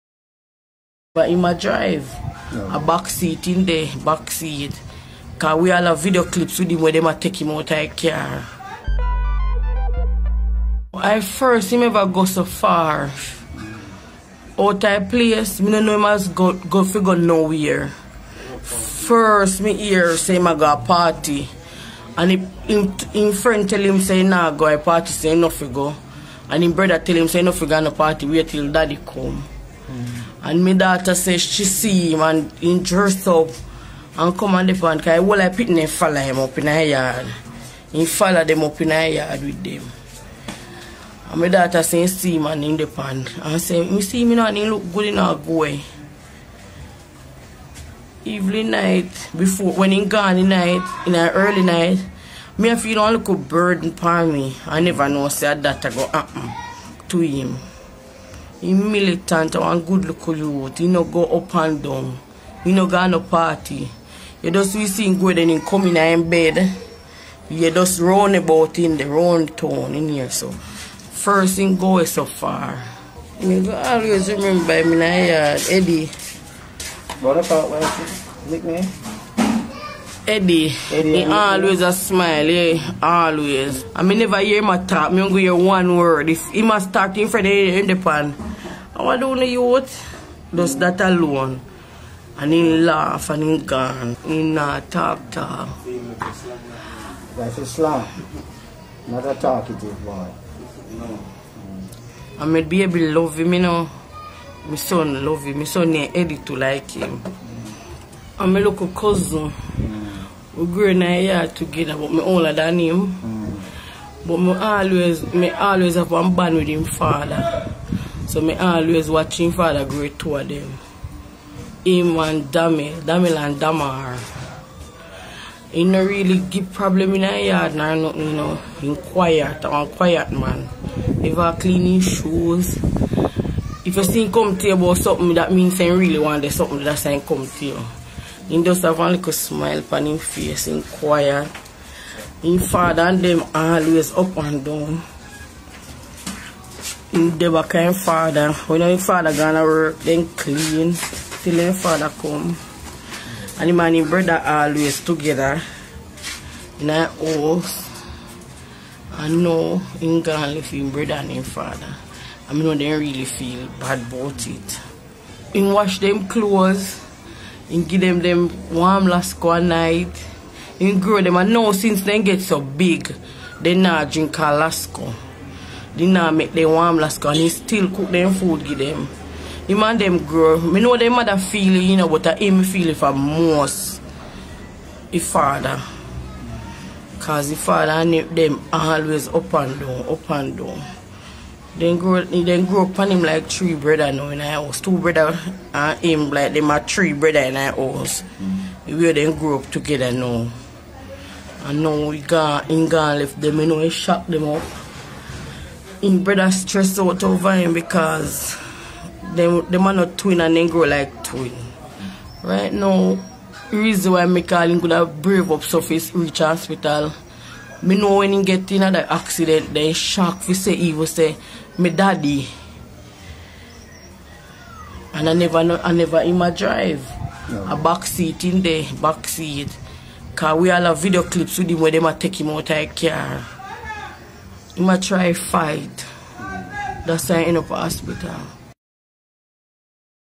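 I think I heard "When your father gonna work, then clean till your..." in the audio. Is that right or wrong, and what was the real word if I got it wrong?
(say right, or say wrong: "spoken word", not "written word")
right.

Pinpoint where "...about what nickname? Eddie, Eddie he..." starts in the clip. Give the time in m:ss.
1:17.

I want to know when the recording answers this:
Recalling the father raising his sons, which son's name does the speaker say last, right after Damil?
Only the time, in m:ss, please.
2:03.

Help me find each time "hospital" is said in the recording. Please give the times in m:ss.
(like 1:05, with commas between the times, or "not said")
3:36, 3:57.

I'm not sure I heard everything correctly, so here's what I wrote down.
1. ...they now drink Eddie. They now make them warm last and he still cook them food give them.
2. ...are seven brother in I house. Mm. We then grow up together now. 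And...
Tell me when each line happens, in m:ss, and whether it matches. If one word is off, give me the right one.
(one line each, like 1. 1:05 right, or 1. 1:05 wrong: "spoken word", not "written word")
1. 2:53 wrong: "Alaska", not "Eddie"
2. 3:16 wrong: "three", not "seven".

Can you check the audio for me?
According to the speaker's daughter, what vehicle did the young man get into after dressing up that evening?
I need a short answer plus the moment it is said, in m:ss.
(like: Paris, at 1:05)
Van, at 0:34.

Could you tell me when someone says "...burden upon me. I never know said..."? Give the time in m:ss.
0:53.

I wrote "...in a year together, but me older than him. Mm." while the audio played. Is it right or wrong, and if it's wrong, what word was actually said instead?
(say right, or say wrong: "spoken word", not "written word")
right.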